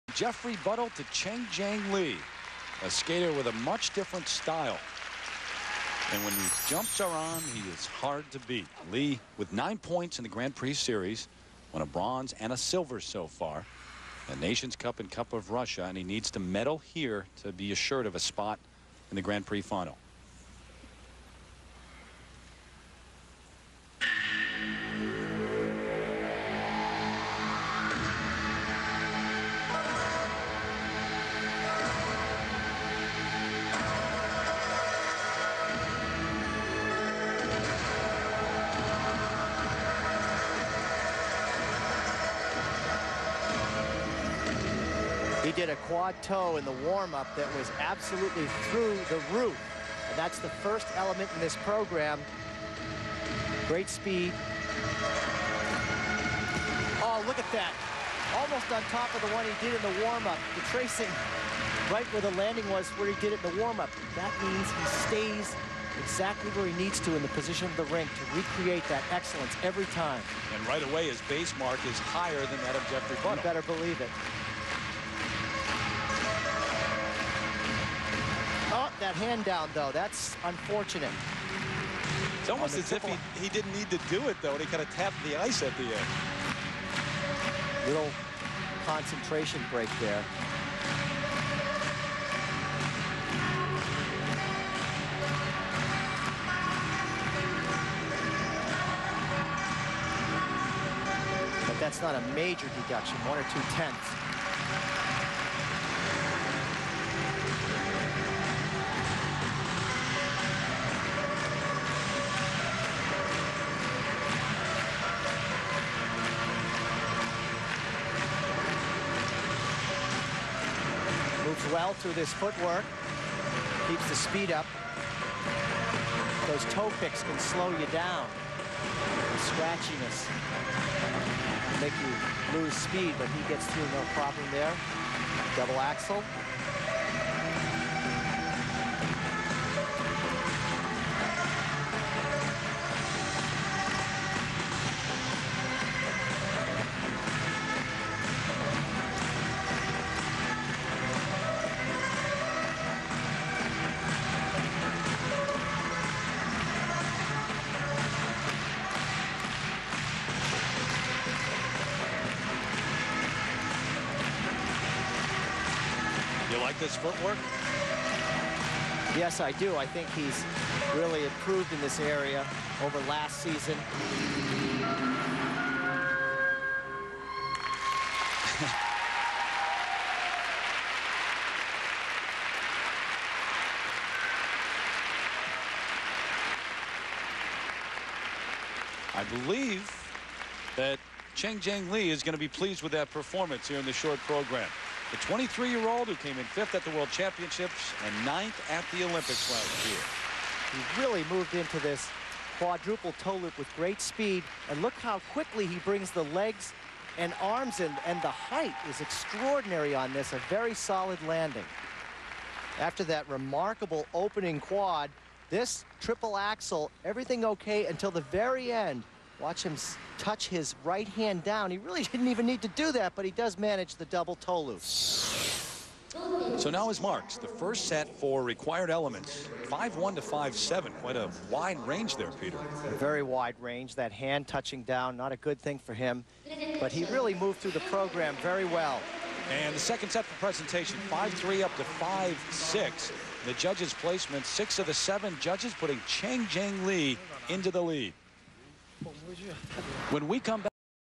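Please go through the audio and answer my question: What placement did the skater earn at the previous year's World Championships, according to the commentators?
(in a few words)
5th.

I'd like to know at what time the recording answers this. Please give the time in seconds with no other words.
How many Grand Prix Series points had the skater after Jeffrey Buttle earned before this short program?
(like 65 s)
9 s.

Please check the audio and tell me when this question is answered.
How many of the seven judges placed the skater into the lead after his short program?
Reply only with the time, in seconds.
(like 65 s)
244 s.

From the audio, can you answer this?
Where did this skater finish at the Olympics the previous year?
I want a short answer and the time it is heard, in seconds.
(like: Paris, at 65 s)
9th, at 198 s.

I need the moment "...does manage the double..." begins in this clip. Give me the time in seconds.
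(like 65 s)
223 s.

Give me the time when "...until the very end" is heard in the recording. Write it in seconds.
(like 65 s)
217 s.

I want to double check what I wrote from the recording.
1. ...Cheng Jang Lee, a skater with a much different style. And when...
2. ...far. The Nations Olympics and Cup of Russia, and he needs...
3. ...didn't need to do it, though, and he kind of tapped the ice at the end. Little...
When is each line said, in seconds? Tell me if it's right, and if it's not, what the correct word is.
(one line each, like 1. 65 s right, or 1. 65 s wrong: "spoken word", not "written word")
1. 1 s right
2. 13 s wrong: "Cup", not "Olympics"
3. 83 s right.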